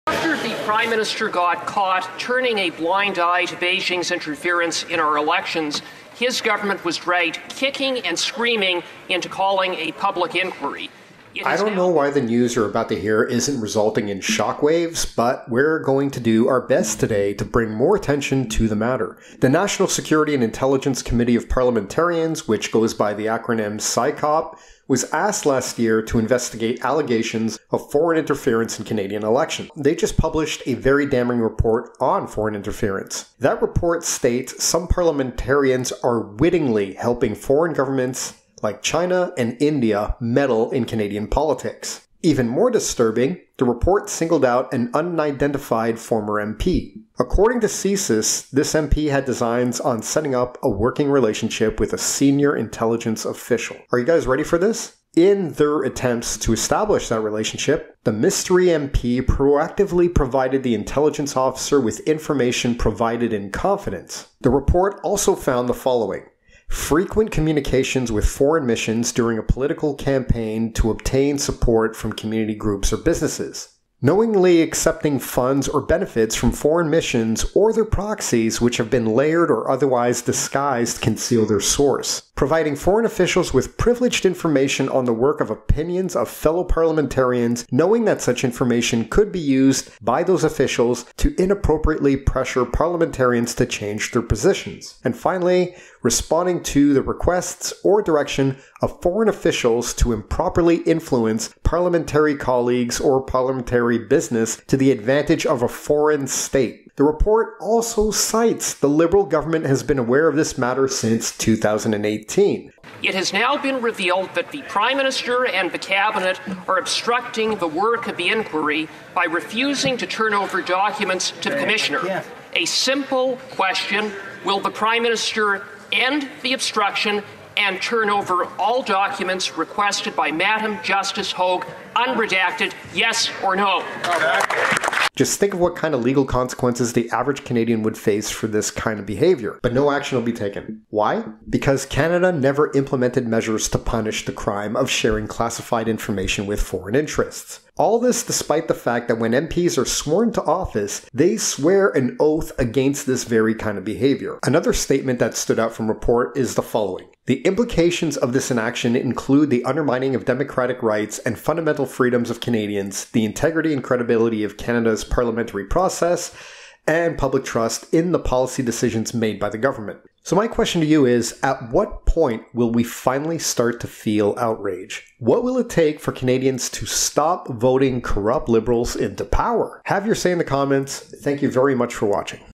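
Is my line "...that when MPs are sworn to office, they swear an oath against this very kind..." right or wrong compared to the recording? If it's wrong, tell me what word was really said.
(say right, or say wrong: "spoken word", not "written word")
right.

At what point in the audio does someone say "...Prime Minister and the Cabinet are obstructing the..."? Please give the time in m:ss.
1:54.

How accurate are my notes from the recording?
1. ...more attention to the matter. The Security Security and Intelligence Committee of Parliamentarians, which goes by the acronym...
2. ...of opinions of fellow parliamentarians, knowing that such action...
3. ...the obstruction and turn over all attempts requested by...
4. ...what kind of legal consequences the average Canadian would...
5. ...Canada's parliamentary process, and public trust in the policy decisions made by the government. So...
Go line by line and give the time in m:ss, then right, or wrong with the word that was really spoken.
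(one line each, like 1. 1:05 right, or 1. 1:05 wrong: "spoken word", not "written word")
1. 0:17 wrong: "National", not "Security"
2. 1:25 wrong: "information", not "action"
3. 2:06 wrong: "documents", not "attempts"
4. 2:15 right
5. 2:44 right.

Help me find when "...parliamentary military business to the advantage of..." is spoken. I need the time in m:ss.
1:43.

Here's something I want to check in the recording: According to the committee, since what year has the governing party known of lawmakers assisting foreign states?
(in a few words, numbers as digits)
2018.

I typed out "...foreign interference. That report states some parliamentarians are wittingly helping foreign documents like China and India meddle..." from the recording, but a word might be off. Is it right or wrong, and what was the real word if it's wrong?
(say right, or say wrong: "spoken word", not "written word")
wrong: "governments", not "documents".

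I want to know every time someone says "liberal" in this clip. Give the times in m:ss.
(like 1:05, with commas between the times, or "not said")
1:48, 2:58.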